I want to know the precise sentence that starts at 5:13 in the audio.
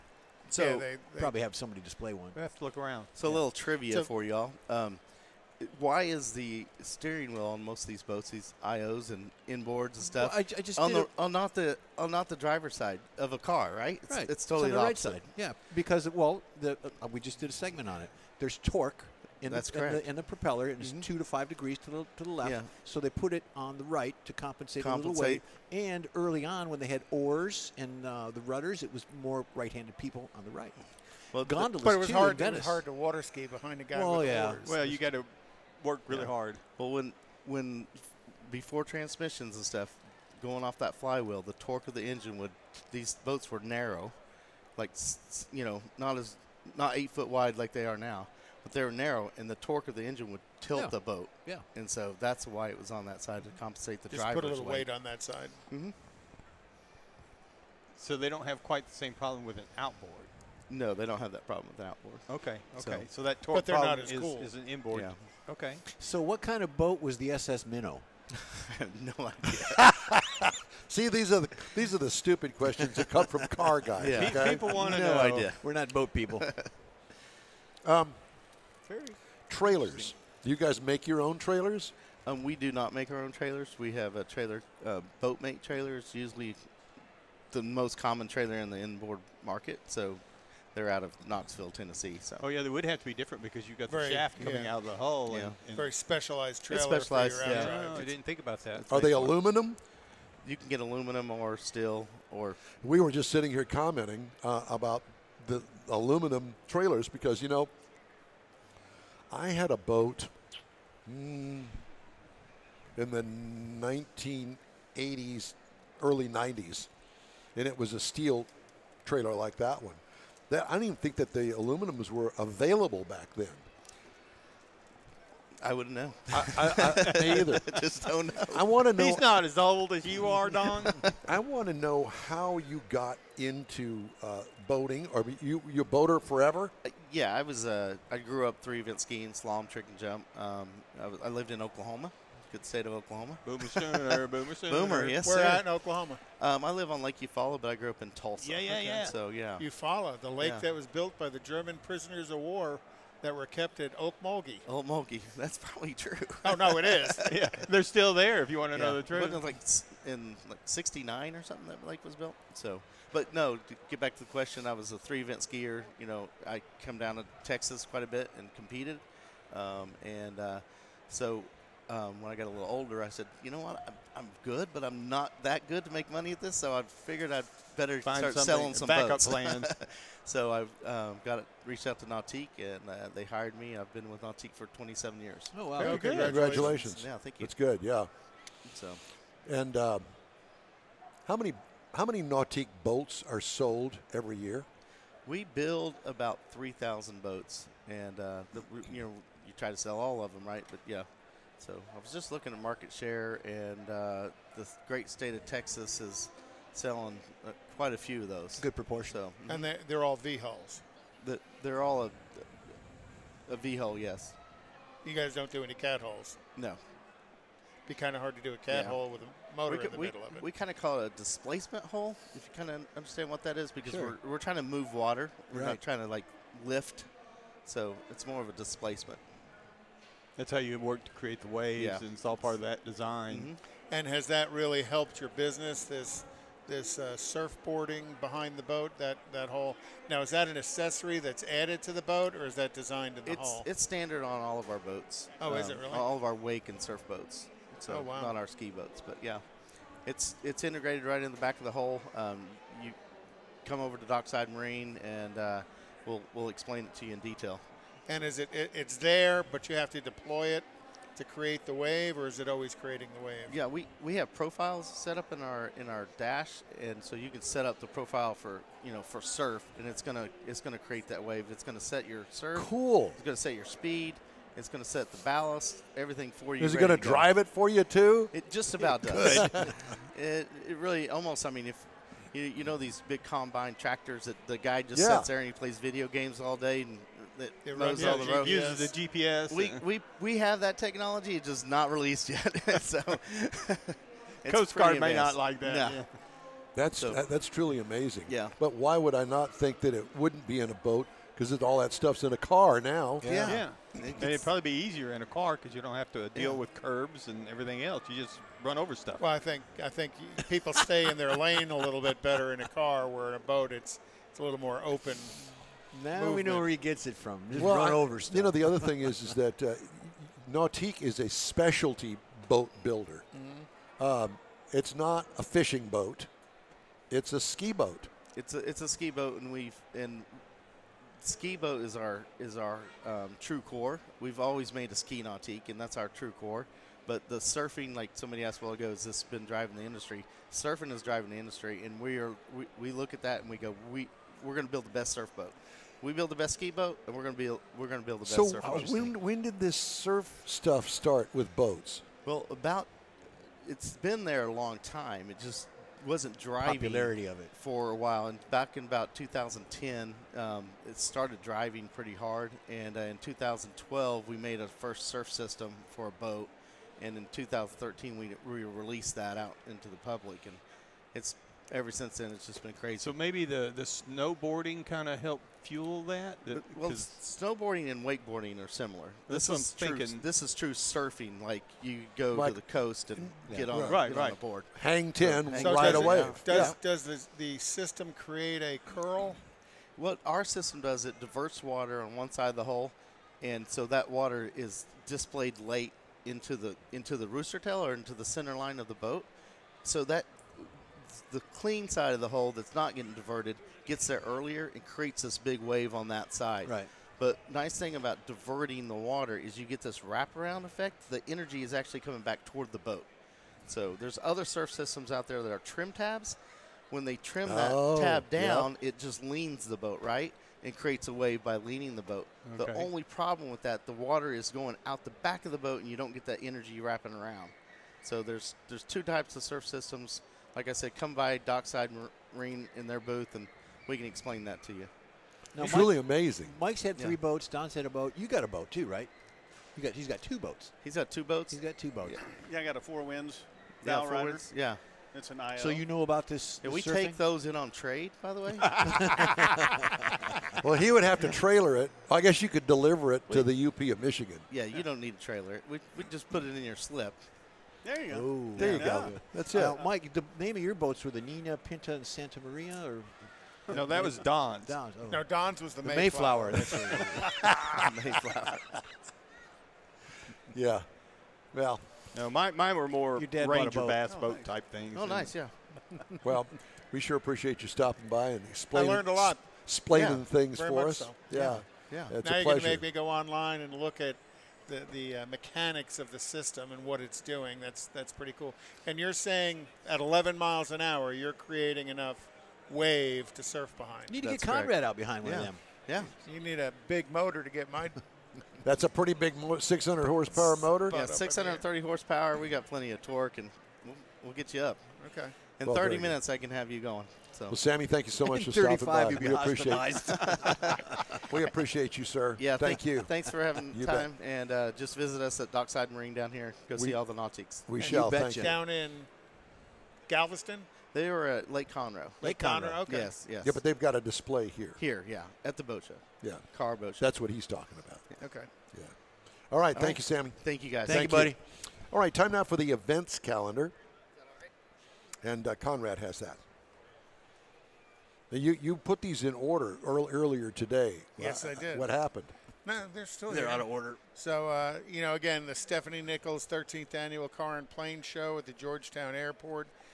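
Where in a boat, it's it's a little more open.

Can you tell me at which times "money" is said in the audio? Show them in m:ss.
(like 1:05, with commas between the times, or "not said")
2:56.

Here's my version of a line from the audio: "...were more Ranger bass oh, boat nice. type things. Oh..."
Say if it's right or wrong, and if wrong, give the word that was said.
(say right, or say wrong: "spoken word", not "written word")
right.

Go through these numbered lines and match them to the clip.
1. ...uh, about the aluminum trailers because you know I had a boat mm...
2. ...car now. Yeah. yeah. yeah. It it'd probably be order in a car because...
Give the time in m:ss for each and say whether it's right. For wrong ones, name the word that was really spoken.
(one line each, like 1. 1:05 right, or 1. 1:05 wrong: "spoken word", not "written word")
1. 1:44 right
2. 5:02 wrong: "easier", not "order".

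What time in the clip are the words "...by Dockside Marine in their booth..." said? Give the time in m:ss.
7:11.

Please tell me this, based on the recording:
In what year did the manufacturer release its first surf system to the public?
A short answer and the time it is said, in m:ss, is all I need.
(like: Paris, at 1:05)
2013, at 6:07.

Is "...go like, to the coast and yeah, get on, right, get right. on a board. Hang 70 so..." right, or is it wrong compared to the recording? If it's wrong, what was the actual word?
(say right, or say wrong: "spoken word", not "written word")
wrong: "10", not "70".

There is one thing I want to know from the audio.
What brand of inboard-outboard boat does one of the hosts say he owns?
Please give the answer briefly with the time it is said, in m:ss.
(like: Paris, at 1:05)
Four Winns, at 7:22.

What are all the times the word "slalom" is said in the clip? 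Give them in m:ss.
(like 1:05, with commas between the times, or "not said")
2:19.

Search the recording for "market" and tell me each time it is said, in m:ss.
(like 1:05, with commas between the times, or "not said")
1:29, 3:22.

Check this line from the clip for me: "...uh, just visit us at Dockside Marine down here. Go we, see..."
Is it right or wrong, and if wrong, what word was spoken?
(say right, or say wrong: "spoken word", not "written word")
right.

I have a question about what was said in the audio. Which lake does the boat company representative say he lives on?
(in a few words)
Lake Eufaula.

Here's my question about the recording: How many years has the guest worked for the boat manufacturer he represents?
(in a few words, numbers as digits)
27 years.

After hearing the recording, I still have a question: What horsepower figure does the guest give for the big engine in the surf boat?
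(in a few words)
630.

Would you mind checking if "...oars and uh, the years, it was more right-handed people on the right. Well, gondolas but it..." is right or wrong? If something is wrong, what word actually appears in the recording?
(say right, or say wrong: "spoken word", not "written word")
wrong: "rudders", not "years".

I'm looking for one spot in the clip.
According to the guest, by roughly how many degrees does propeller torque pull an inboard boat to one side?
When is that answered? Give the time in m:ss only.
0:21.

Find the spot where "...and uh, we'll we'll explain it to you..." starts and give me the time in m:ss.
4:15.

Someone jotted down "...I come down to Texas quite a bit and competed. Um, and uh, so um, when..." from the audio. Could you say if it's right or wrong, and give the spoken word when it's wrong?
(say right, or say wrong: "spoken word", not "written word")
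right.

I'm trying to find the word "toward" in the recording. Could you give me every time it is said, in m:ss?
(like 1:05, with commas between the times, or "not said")
6:52.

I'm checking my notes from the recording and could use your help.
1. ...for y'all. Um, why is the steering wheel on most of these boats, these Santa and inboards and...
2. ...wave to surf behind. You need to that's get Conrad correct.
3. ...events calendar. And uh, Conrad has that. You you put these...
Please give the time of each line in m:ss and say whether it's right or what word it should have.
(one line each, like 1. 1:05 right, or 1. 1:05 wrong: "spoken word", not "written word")
1. 0:04 wrong: "IOs", not "Santa"
2. 8:12 right
3. 8:52 right.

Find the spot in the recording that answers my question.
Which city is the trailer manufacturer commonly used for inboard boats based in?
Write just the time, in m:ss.
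1:31.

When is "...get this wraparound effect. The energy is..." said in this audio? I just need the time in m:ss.
6:49.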